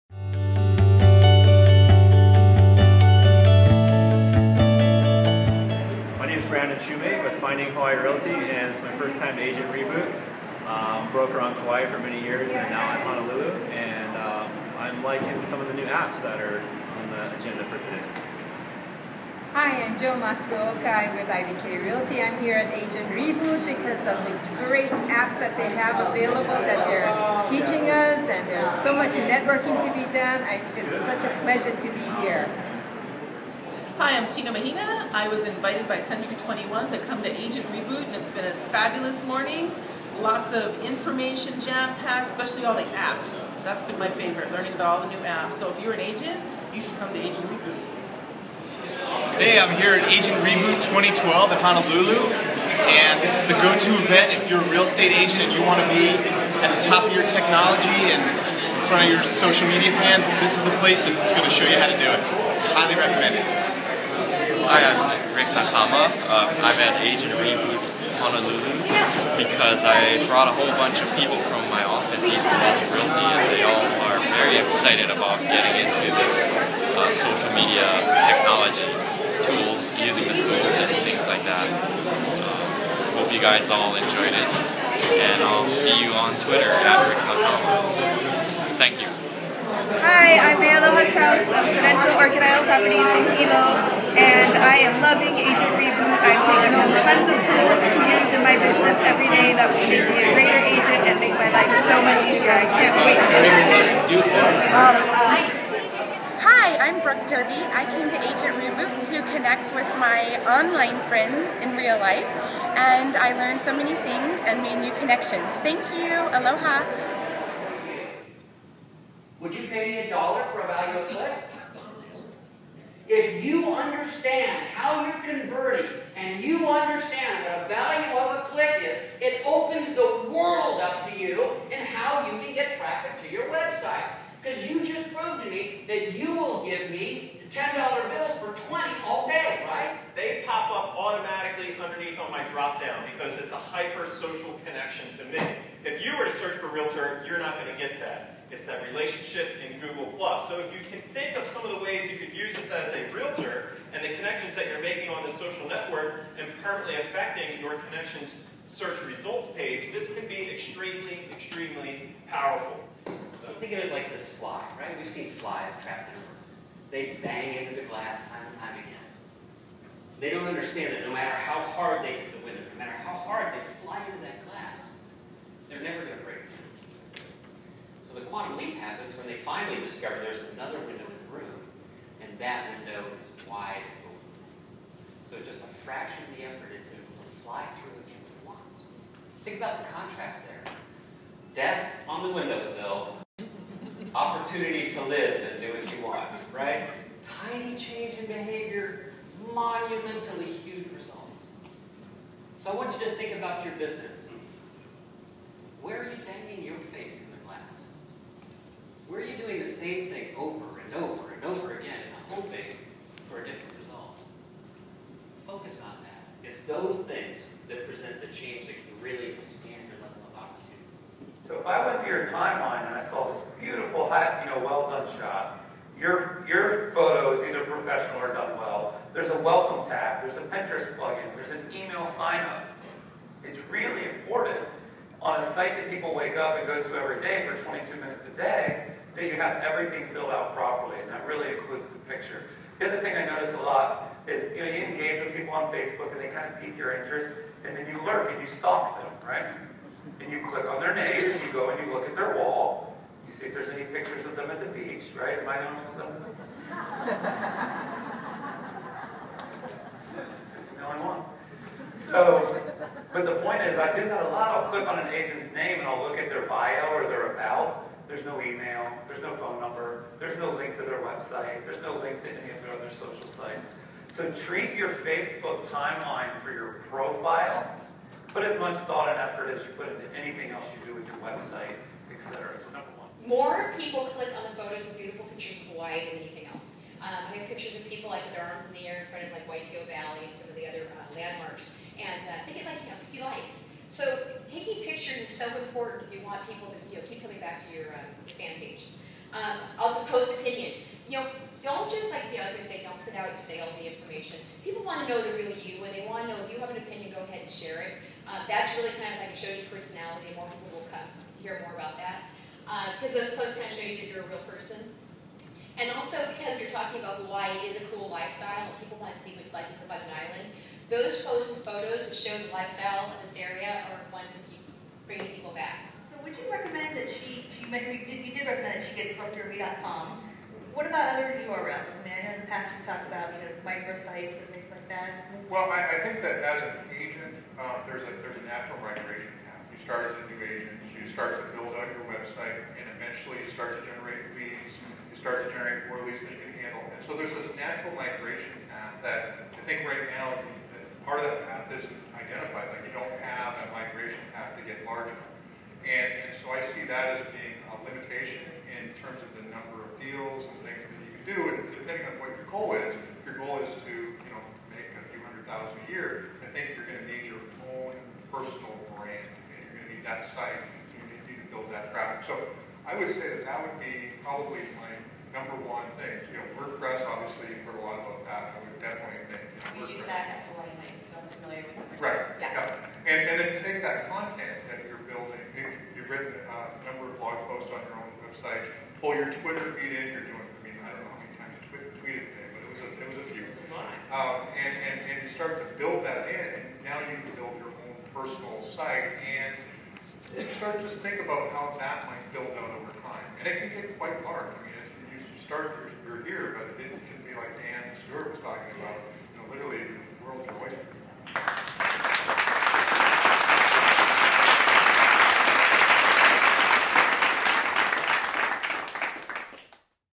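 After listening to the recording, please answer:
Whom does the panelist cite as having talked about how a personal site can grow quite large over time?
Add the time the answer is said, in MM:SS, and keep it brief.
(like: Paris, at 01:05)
Dan Stewart, at 06:47.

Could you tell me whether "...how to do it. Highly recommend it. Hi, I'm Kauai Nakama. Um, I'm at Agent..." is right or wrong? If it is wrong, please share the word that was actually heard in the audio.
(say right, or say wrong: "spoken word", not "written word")
wrong: "Rick", not "Kauai".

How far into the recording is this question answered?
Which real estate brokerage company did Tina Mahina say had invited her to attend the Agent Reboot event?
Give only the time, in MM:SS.
00:35.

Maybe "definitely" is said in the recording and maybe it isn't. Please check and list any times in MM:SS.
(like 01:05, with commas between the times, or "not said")
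06:18.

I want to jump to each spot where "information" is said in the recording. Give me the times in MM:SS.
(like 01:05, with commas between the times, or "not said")
00:40, 05:03.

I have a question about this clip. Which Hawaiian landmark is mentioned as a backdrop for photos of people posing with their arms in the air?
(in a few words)
Waipio Valley.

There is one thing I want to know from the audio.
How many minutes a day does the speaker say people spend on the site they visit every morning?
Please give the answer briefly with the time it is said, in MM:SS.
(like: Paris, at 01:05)
22, at 03:57.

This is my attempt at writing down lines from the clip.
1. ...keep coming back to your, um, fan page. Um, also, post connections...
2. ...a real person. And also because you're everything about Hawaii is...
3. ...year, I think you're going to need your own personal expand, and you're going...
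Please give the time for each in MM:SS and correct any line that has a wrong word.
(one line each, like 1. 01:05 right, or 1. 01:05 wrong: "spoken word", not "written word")
1. 04:57 wrong: "opinions", not "connections"
2. 05:14 wrong: "talking", not "everything"
3. 06:05 wrong: "brand", not "expand".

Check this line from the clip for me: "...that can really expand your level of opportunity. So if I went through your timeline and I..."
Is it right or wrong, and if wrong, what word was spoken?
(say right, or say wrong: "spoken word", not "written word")
right.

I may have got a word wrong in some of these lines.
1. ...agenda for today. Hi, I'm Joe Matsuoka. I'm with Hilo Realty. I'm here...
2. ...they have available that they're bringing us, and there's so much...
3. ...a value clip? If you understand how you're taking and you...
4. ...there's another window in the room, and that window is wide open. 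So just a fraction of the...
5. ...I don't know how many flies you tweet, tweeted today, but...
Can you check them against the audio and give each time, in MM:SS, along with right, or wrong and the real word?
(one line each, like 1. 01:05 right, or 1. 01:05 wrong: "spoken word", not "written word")
1. 00:17 wrong: "IBK", not "Hilo"
2. 00:25 wrong: "teaching", not "bringing"
3. 02:00 wrong: "converting", not "taking"
4. 03:00 right
5. 06:30 wrong: "times", not "flies".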